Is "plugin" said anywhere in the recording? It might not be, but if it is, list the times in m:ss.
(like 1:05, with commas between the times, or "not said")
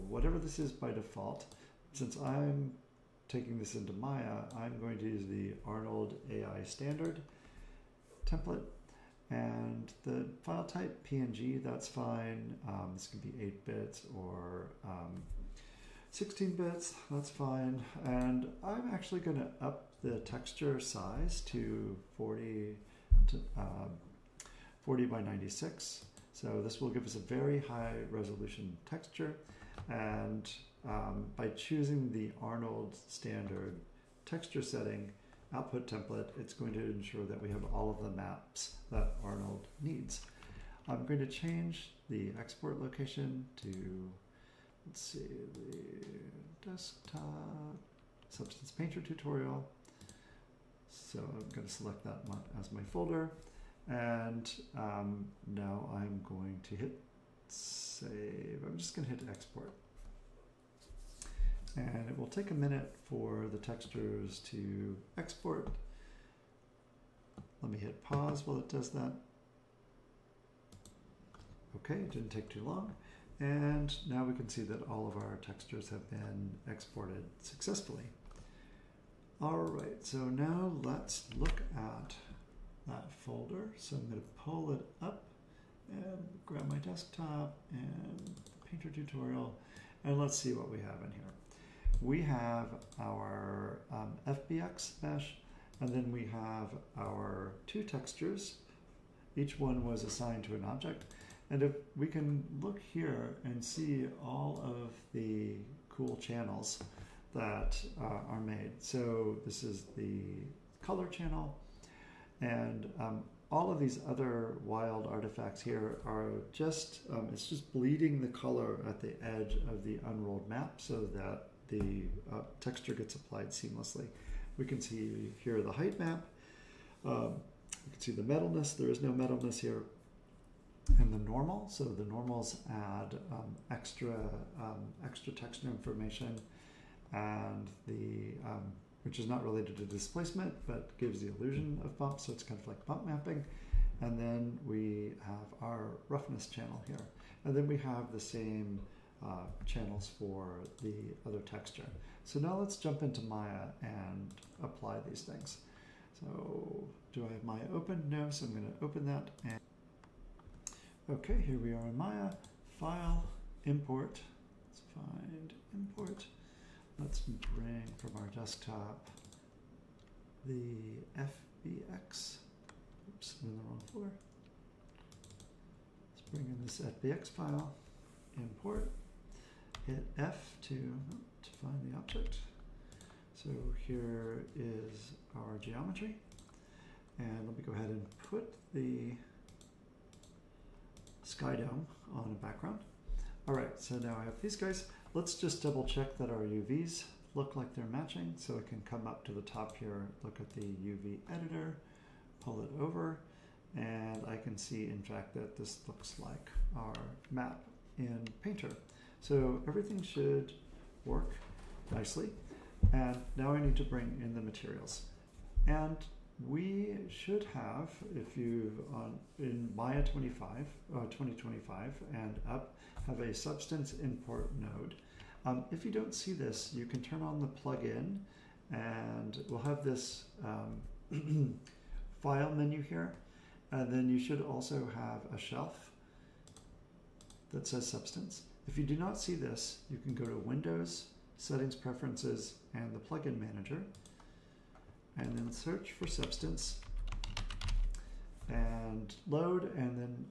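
3:47, 4:02.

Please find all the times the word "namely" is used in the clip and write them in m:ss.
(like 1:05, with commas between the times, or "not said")
not said.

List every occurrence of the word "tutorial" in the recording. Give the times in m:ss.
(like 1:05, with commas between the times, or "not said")
0:49, 1:28.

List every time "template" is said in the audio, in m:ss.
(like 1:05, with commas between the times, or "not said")
0:08, 0:35.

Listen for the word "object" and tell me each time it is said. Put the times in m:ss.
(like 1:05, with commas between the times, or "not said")
1:40, 3:01.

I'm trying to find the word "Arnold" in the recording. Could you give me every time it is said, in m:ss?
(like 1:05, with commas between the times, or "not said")
0:05, 0:32, 0:39.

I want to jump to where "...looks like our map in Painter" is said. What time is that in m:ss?
3:25.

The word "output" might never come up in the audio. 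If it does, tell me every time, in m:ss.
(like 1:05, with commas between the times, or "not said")
0:35.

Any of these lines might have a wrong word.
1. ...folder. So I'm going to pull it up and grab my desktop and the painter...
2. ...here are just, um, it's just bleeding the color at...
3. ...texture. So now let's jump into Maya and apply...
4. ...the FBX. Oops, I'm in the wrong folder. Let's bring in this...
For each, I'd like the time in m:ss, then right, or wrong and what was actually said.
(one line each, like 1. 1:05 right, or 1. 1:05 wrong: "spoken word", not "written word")
1. 1:23 right
2. 1:55 right
3. 2:31 right
4. 2:50 right.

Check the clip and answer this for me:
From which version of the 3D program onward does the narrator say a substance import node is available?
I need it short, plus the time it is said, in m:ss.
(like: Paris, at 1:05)
2025, at 3:41.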